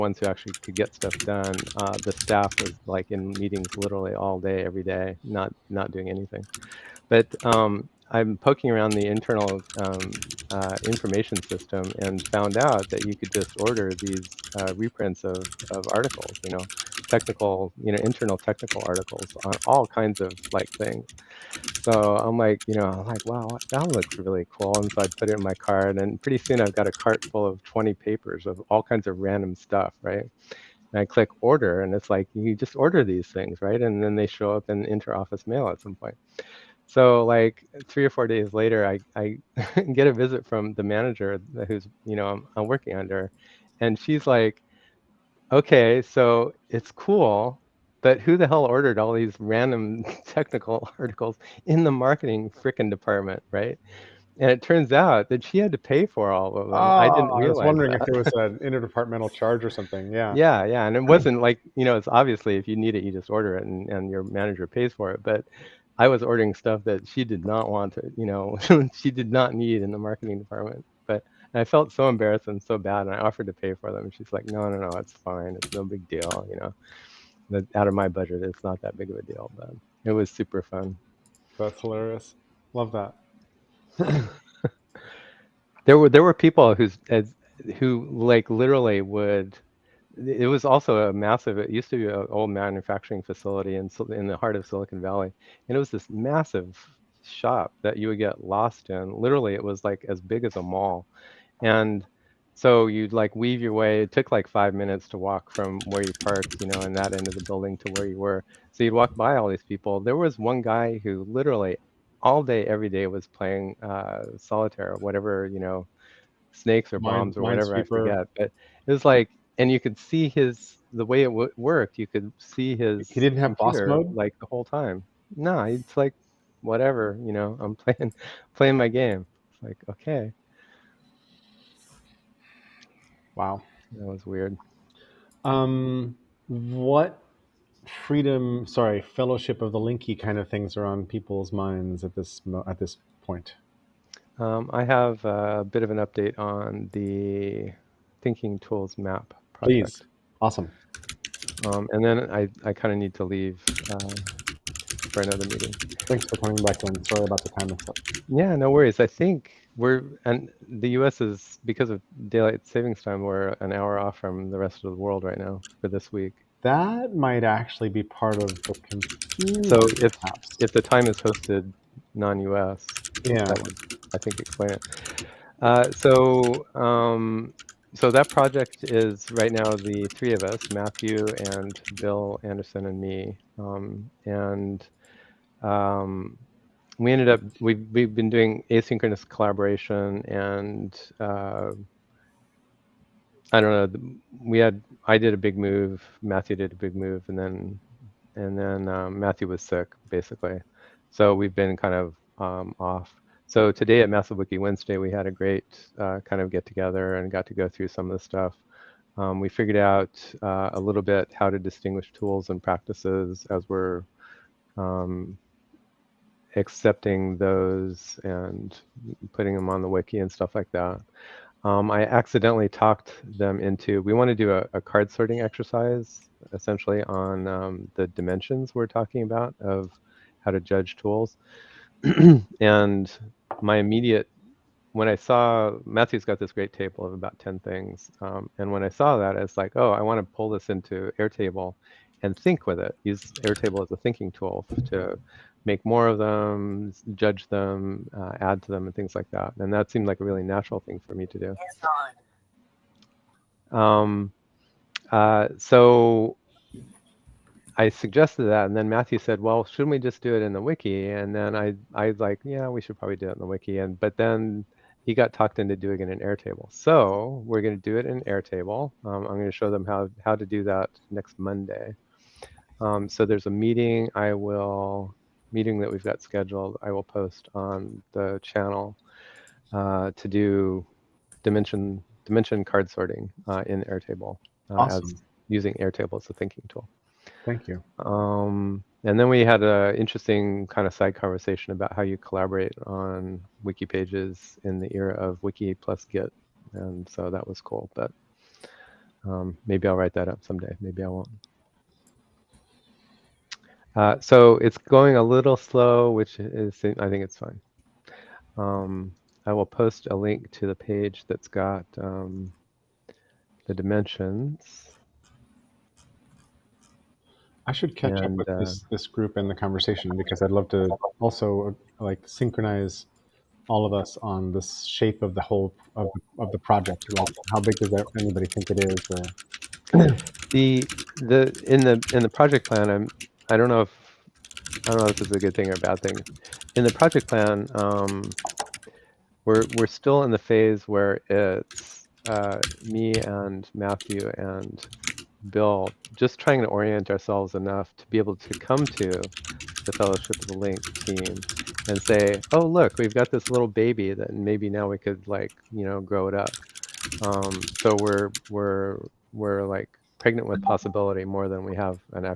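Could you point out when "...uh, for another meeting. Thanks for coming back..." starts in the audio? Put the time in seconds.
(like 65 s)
153 s.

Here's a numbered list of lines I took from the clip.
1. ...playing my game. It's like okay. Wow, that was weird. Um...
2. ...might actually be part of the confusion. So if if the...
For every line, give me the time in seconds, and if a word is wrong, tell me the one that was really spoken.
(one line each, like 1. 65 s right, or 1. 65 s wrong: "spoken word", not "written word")
1. 128 s right
2. 167 s right.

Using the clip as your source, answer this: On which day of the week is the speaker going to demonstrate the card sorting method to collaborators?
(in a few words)
Monday.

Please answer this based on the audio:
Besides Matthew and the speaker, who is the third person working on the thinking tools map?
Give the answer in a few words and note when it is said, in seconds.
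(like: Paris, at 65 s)
Bill Anderson, at 181 s.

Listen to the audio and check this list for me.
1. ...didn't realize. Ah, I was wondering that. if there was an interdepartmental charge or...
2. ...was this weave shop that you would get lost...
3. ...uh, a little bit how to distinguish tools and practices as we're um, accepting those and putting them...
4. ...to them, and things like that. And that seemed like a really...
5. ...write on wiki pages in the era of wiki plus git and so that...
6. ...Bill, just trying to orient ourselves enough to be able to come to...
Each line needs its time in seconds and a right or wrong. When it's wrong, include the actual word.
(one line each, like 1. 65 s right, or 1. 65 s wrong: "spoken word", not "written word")
1. 57 s right
2. 95 s wrong: "massive", not "weave"
3. 210 s right
4. 248 s right
5. 292 s wrong: "collaborate", not "write"
6. 345 s right.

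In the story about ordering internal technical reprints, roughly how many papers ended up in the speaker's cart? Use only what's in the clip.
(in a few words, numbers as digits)
20.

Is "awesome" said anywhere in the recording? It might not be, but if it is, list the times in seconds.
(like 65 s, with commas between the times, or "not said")
150 s, 284 s.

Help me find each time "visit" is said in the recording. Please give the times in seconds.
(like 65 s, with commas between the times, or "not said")
40 s.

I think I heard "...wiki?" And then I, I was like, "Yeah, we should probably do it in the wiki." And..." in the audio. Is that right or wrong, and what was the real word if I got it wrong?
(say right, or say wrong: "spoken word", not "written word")
right.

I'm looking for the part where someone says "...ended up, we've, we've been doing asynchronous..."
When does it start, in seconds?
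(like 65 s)
187 s.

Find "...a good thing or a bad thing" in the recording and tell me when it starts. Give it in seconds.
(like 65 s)
335 s.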